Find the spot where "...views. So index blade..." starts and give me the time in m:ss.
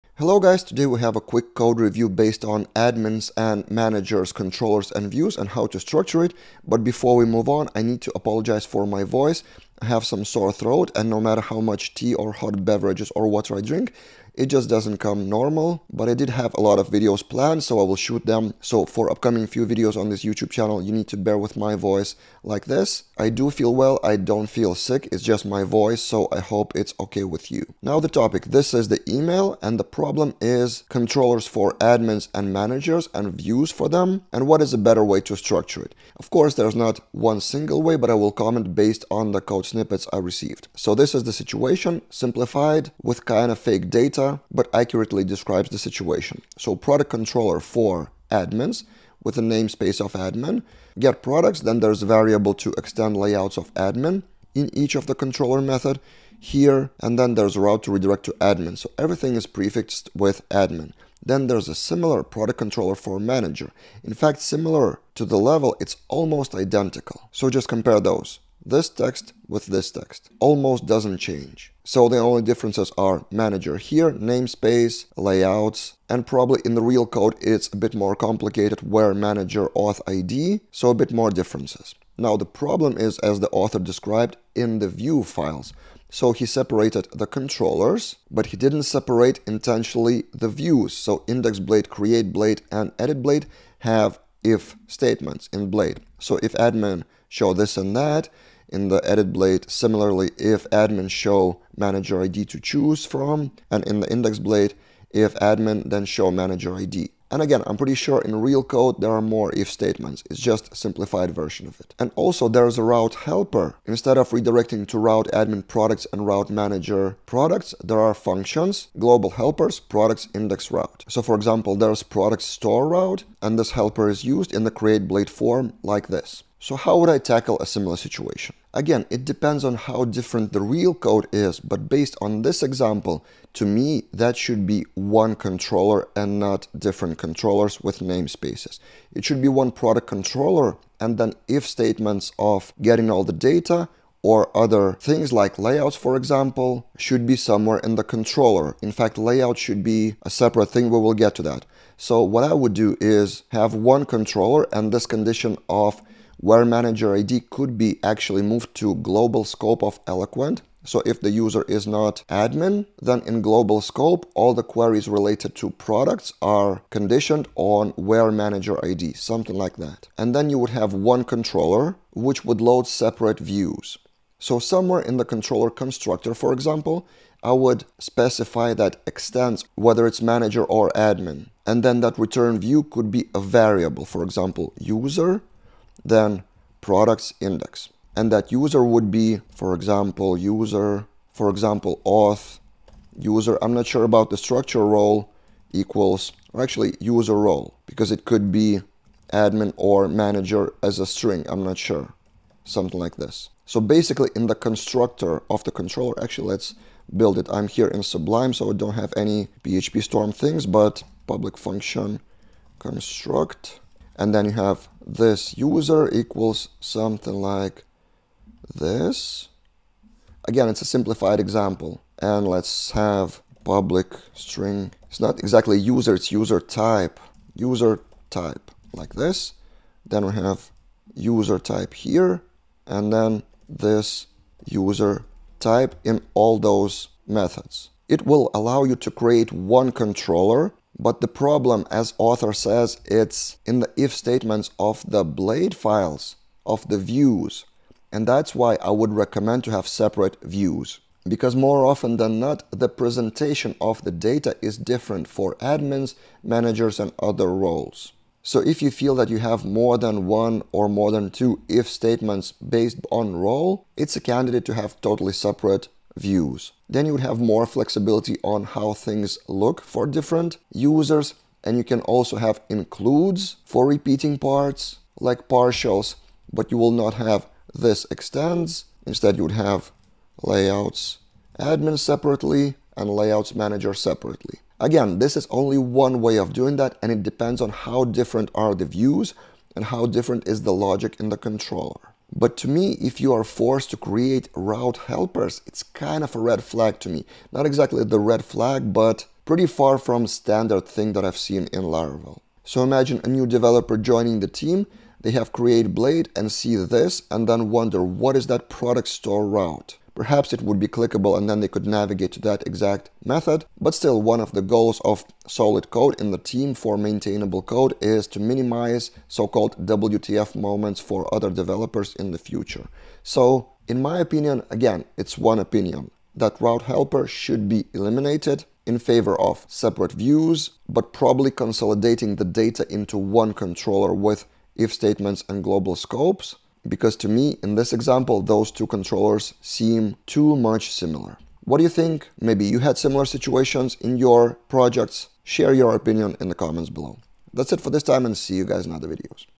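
1:30.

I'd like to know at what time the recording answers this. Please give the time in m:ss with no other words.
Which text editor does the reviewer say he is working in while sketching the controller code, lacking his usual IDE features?
3:28.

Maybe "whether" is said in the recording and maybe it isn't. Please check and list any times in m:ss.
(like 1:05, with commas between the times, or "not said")
2:59.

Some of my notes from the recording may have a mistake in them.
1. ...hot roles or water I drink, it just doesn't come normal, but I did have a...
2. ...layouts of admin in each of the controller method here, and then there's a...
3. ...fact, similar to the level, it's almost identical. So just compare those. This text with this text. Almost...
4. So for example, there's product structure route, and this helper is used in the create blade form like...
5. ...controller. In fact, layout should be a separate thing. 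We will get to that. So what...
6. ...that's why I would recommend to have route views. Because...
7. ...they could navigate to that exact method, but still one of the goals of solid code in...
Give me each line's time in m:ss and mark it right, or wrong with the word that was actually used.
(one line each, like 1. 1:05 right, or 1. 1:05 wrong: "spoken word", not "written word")
1. 0:12 wrong: "beverages", not "roles"
2. 0:53 right
3. 1:04 right
4. 2:01 wrong: "store", not "structure"
5. 2:28 right
6. 4:08 wrong: "separate", not "route"
7. 5:11 right.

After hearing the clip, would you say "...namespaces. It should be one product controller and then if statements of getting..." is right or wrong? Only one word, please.
right.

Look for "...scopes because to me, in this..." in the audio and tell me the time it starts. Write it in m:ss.
5:35.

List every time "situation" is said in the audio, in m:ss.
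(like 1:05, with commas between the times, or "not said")
0:41, 0:45, 2:07, 5:43.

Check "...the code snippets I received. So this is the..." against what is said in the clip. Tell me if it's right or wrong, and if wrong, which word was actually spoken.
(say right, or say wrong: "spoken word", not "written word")
right.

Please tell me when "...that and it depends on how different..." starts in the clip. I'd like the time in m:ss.
4:46.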